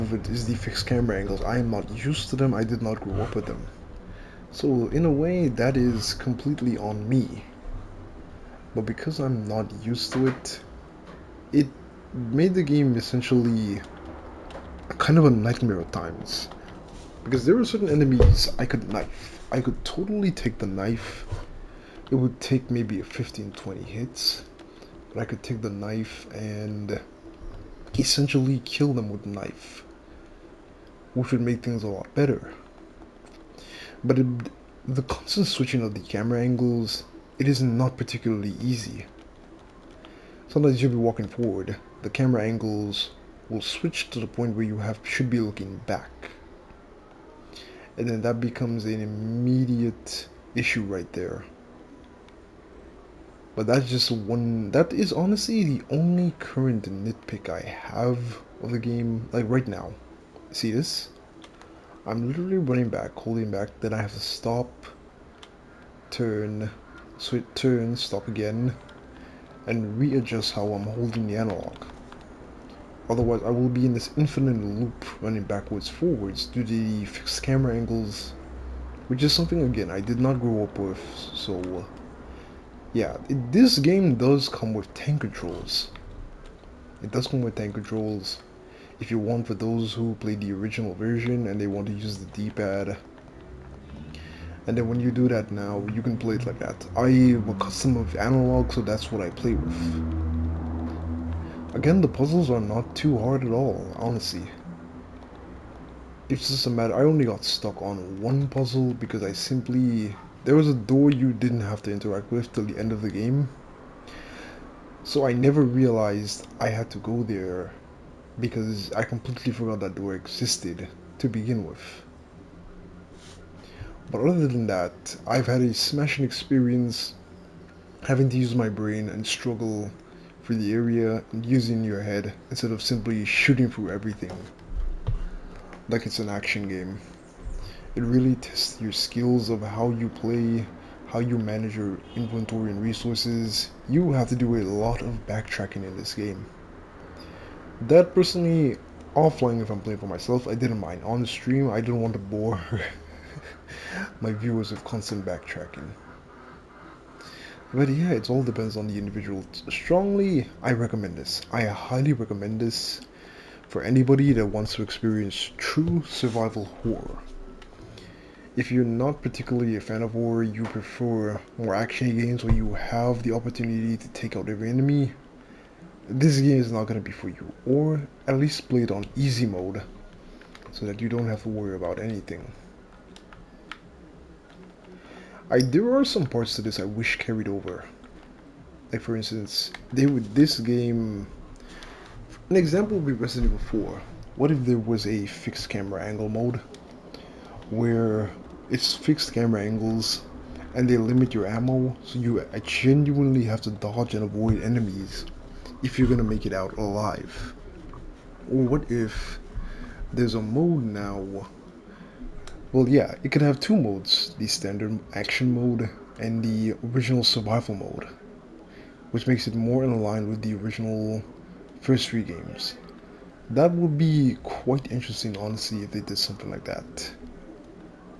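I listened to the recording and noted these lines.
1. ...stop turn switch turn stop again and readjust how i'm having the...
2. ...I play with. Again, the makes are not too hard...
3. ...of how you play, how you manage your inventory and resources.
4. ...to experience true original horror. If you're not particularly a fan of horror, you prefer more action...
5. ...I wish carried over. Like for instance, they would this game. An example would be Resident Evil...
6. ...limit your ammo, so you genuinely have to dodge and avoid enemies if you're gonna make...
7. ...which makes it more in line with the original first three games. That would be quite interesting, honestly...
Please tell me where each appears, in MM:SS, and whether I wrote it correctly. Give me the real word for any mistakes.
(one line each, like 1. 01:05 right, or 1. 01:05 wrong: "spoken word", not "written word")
1. 01:04 wrong: "holding", not "having"
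2. 01:39 wrong: "puzzles", not "makes"
3. 02:19 right
4. 02:44 wrong: "survival", not "original"
5. 03:06 right
6. 03:20 right
7. 03:39 right.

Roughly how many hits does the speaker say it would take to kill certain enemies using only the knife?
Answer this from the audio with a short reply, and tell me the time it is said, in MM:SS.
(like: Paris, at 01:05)
15-20, at 00:23.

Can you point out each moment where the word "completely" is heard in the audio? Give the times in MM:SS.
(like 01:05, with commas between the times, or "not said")
00:06, 01:59.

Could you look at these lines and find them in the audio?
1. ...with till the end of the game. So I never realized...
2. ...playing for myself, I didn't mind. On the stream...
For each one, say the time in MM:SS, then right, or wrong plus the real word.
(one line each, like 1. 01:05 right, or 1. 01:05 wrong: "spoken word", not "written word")
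1. 01:52 right
2. 02:29 right.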